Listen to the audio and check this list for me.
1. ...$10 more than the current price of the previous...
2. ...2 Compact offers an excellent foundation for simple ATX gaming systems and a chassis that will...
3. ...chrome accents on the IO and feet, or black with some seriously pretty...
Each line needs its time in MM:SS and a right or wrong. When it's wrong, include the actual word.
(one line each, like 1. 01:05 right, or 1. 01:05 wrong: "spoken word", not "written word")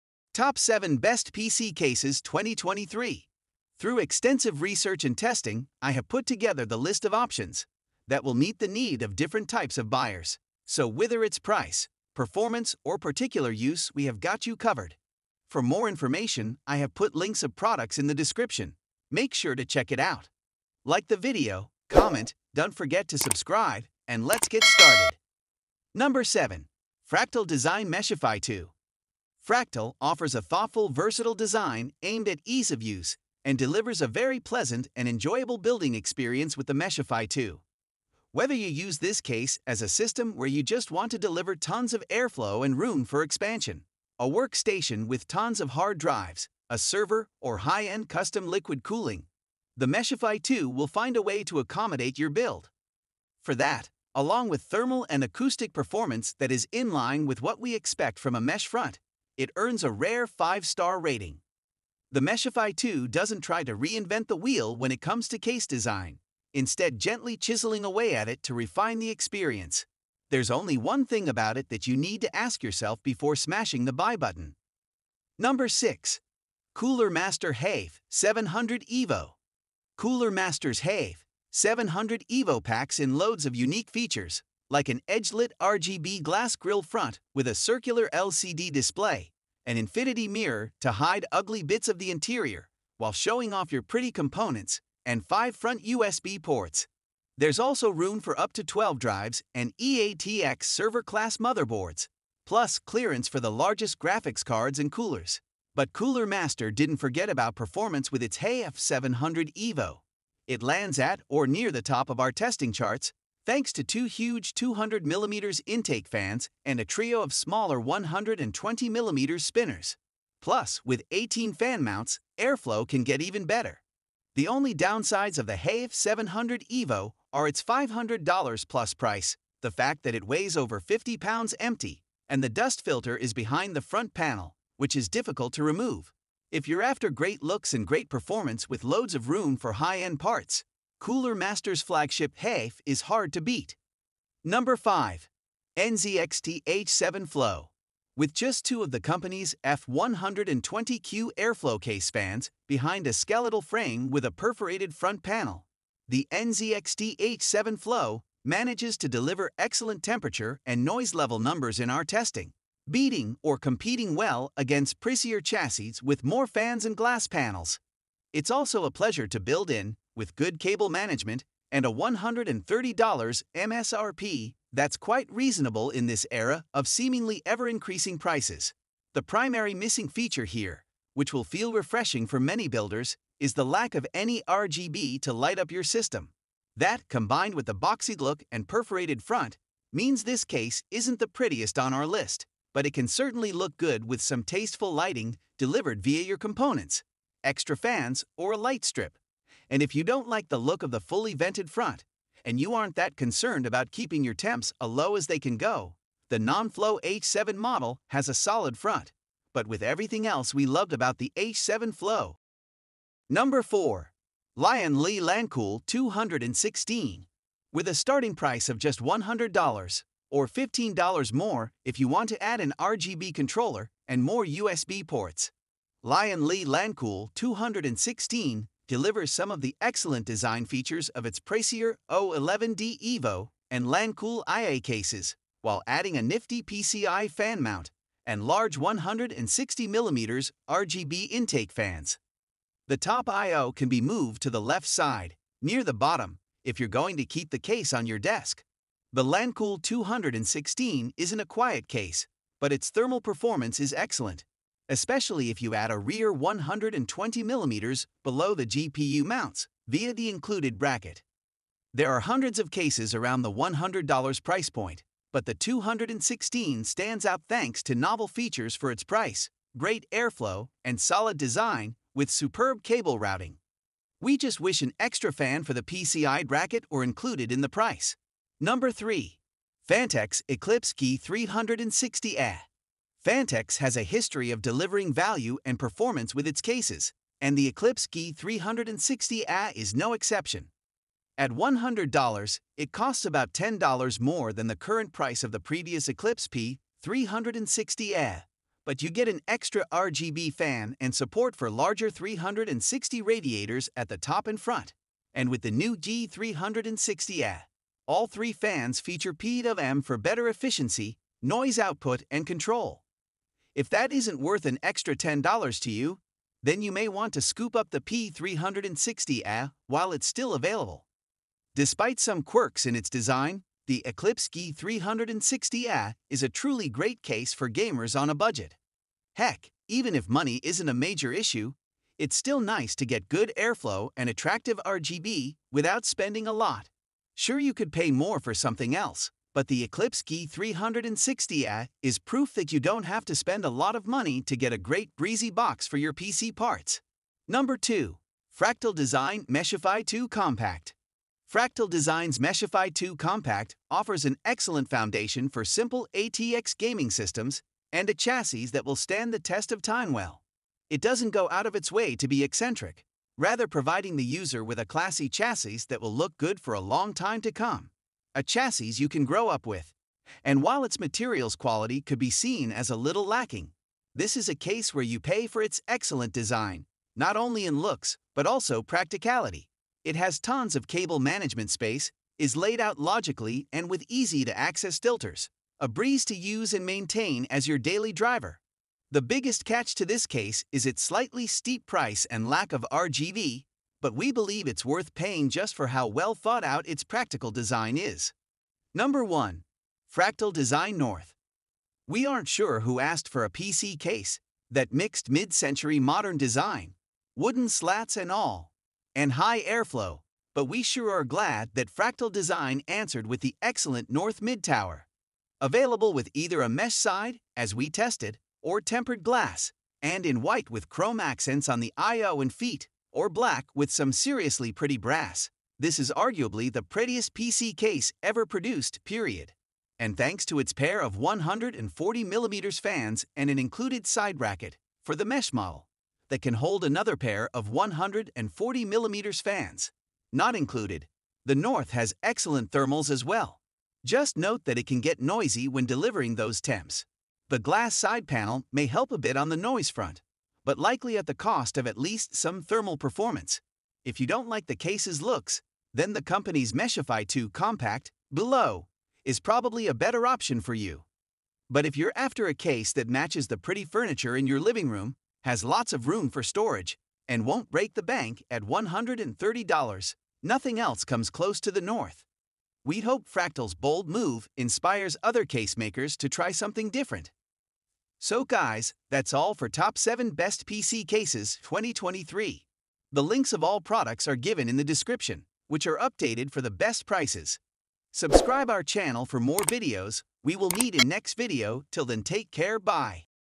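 1. 04:53 right
2. 05:52 right
3. 07:00 right.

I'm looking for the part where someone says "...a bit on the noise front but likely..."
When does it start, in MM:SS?
07:29.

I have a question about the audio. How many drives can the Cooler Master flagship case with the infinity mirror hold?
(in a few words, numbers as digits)
12.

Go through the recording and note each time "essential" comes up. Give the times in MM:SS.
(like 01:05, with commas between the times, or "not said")
not said.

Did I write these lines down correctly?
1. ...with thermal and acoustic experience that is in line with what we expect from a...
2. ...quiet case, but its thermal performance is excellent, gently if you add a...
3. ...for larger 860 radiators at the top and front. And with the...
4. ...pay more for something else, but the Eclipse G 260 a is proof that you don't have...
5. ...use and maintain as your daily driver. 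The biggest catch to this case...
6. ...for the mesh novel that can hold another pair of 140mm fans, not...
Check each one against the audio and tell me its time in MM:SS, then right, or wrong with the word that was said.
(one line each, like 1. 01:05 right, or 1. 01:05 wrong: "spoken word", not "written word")
1. 00:54 wrong: "performance", not "experience"
2. 04:11 wrong: "especially", not "gently"
3. 05:01 wrong: "360", not "860"
4. 05:37 wrong: "360", not "260"
5. 06:26 right
6. 07:15 wrong: "model", not "novel".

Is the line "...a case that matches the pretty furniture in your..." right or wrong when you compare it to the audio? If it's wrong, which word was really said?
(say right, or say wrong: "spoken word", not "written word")
right.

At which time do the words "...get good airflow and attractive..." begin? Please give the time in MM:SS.
05:33.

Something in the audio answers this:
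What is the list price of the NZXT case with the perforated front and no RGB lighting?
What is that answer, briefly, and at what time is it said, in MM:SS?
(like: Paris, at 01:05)
$130, at 02:51.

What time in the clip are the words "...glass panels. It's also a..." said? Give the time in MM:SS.
02:46.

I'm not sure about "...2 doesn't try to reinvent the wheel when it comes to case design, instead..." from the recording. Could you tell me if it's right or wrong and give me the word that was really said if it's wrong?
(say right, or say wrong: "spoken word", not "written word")
right.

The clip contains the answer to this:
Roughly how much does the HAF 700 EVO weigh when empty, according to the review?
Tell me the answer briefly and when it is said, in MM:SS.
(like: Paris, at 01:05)
over 50 pounds, at 02:10.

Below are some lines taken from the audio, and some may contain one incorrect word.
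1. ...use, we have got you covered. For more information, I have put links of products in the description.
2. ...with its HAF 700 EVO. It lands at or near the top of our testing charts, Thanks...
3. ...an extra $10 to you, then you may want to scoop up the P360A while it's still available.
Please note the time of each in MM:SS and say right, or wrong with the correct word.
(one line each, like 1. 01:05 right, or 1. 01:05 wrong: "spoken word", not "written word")
1. 00:13 right
2. 01:48 right
3. 05:14 right.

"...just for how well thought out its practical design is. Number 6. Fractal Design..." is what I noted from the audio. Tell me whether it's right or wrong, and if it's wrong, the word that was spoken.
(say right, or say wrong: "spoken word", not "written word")
wrong: "1", not "6".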